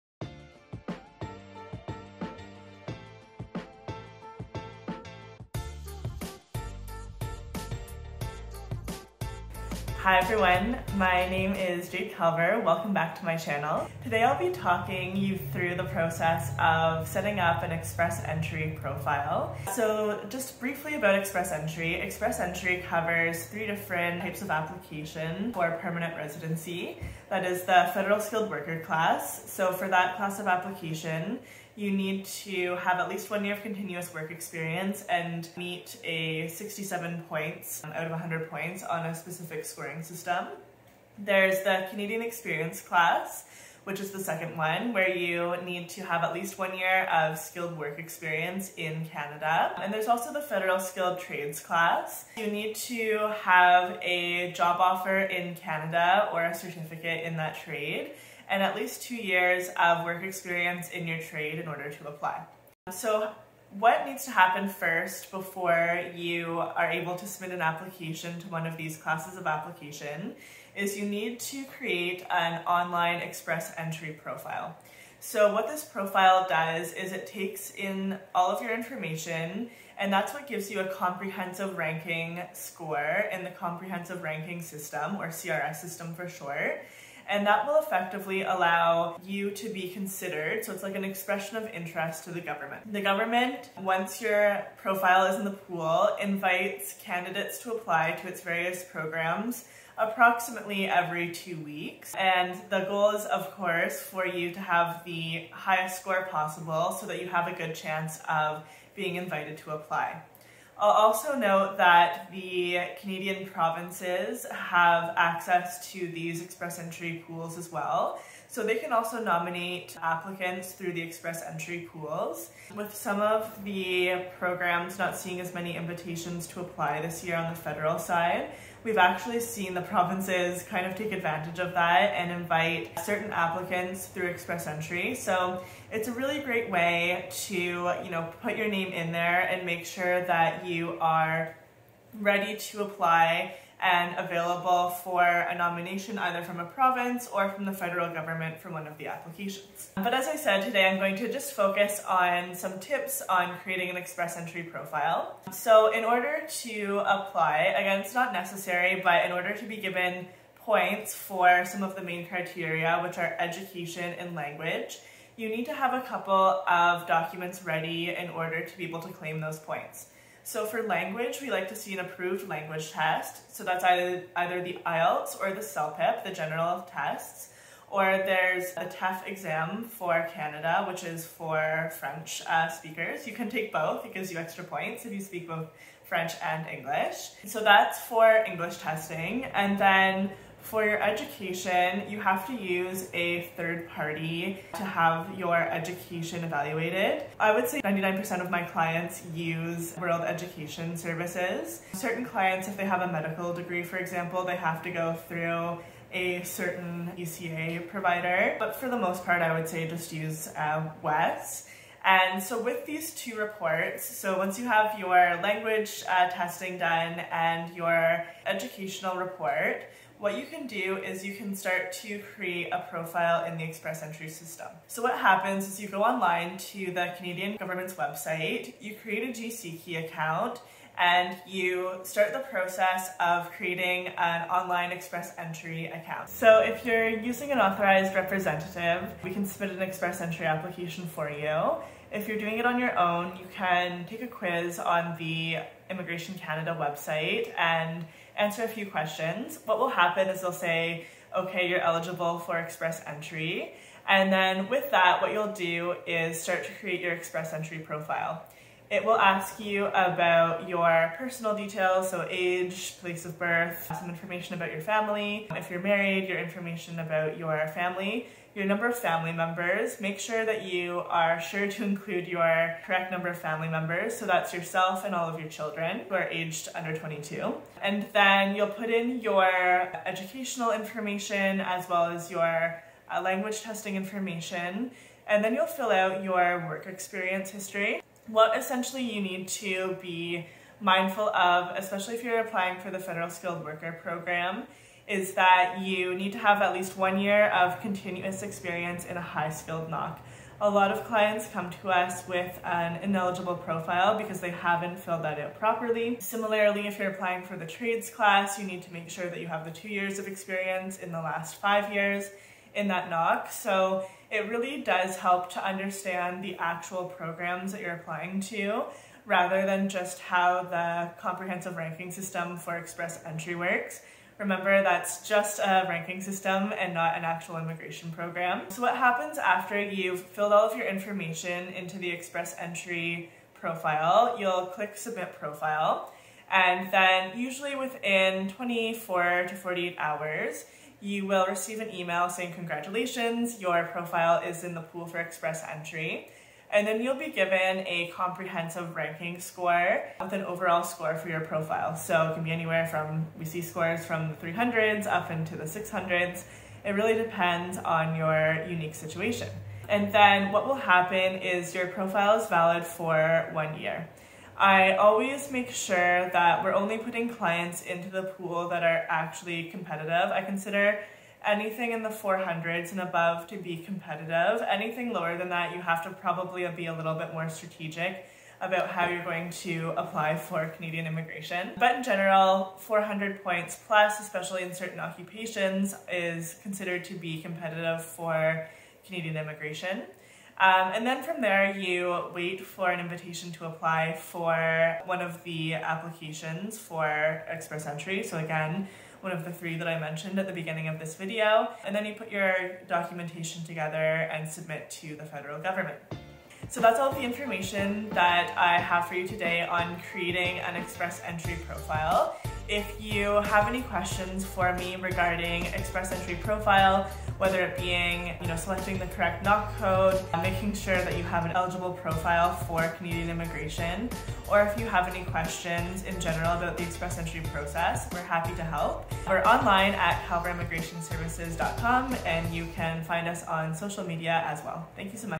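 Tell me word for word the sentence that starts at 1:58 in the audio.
So they can also nominate applicants through the express entry pools.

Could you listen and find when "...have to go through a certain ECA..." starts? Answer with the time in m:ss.
3:24.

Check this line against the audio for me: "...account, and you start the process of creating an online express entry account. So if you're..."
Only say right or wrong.
right.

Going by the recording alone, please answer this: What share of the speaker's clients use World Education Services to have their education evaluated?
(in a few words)
99%.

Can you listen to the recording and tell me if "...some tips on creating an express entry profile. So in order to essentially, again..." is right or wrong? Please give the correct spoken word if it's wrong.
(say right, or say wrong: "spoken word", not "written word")
wrong: "apply", not "essentially".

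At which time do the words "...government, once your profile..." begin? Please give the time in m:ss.
1:33.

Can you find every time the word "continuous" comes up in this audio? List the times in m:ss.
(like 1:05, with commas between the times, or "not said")
0:33, 4:57.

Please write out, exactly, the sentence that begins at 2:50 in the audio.
So for language, we like to see an approved language test.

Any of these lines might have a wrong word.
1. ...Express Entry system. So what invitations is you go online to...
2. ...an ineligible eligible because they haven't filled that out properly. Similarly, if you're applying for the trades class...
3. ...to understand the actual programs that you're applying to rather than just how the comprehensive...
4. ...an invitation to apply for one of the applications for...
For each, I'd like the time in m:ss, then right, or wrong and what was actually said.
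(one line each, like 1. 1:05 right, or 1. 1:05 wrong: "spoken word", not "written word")
1. 3:43 wrong: "happens", not "invitations"
2. 5:02 wrong: "profile", not "eligible"
3. 5:15 right
4. 6:32 right.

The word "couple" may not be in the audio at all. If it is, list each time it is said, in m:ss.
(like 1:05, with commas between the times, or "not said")
2:46.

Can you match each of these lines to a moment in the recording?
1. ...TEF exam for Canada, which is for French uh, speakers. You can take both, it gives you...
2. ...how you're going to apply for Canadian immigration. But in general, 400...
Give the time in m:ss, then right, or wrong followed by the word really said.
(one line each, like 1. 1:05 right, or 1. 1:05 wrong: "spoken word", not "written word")
1. 2:58 right
2. 6:18 right.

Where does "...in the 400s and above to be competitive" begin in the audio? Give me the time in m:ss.
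6:11.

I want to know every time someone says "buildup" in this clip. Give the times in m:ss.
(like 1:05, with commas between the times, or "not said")
not said.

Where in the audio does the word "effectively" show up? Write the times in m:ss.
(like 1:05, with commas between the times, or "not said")
1:27.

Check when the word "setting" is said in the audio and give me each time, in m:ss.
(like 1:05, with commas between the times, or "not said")
0:17.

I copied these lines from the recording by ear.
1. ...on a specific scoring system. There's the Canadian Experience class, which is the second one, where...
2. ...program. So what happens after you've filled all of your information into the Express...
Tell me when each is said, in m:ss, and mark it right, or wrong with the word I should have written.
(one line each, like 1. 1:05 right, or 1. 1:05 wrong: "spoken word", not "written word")
1. 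0:38 right
2. 5:28 right.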